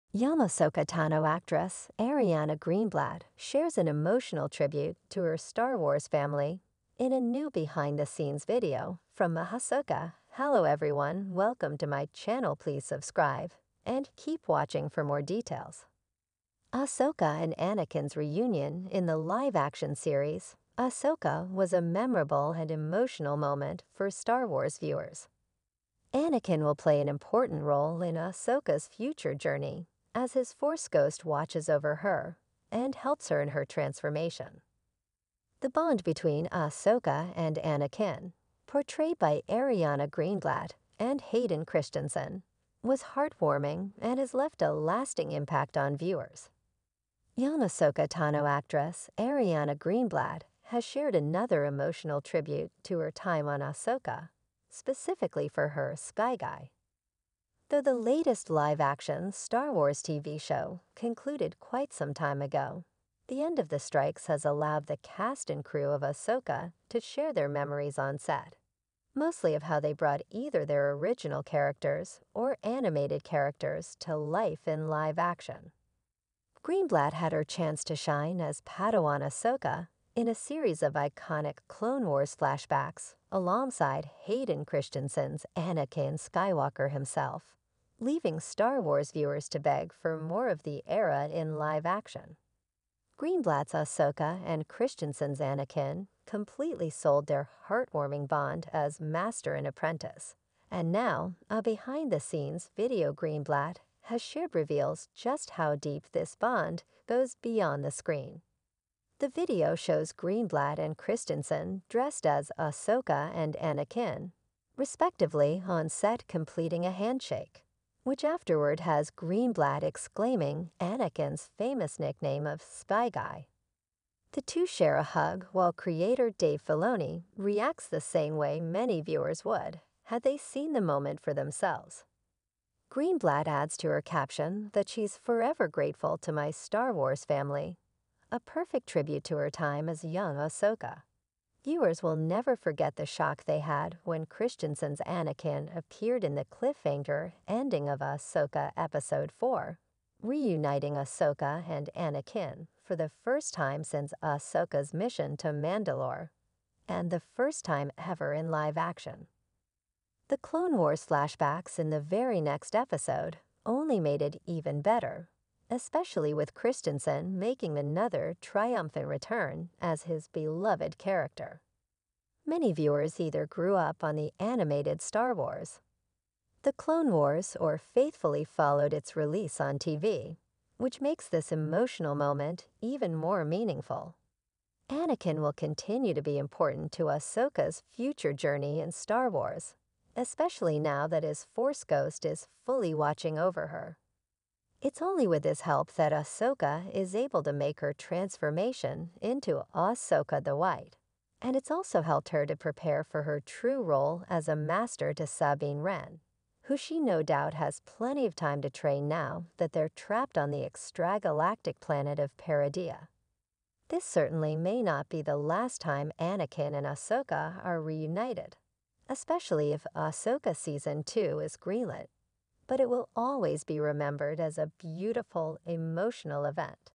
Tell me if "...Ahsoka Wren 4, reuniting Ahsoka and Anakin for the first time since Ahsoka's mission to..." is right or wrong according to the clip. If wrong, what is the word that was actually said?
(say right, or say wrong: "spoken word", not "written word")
wrong: "Episode", not "Wren".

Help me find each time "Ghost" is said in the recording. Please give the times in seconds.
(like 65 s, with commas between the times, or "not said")
30 s, 191 s.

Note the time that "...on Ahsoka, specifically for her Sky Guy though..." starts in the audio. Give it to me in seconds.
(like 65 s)
53 s.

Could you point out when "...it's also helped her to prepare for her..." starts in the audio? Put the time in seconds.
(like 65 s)
201 s.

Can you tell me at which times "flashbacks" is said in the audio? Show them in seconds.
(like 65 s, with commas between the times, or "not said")
82 s, 161 s.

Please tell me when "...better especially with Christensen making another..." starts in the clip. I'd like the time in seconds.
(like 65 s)
164 s.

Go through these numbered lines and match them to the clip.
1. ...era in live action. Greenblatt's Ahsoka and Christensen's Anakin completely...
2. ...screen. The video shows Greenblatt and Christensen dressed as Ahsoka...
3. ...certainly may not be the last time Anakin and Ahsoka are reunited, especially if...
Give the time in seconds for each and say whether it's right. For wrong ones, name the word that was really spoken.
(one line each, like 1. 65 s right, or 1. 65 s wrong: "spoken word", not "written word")
1. 90 s right
2. 107 s right
3. 214 s right.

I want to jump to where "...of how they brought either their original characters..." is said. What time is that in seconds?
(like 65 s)
69 s.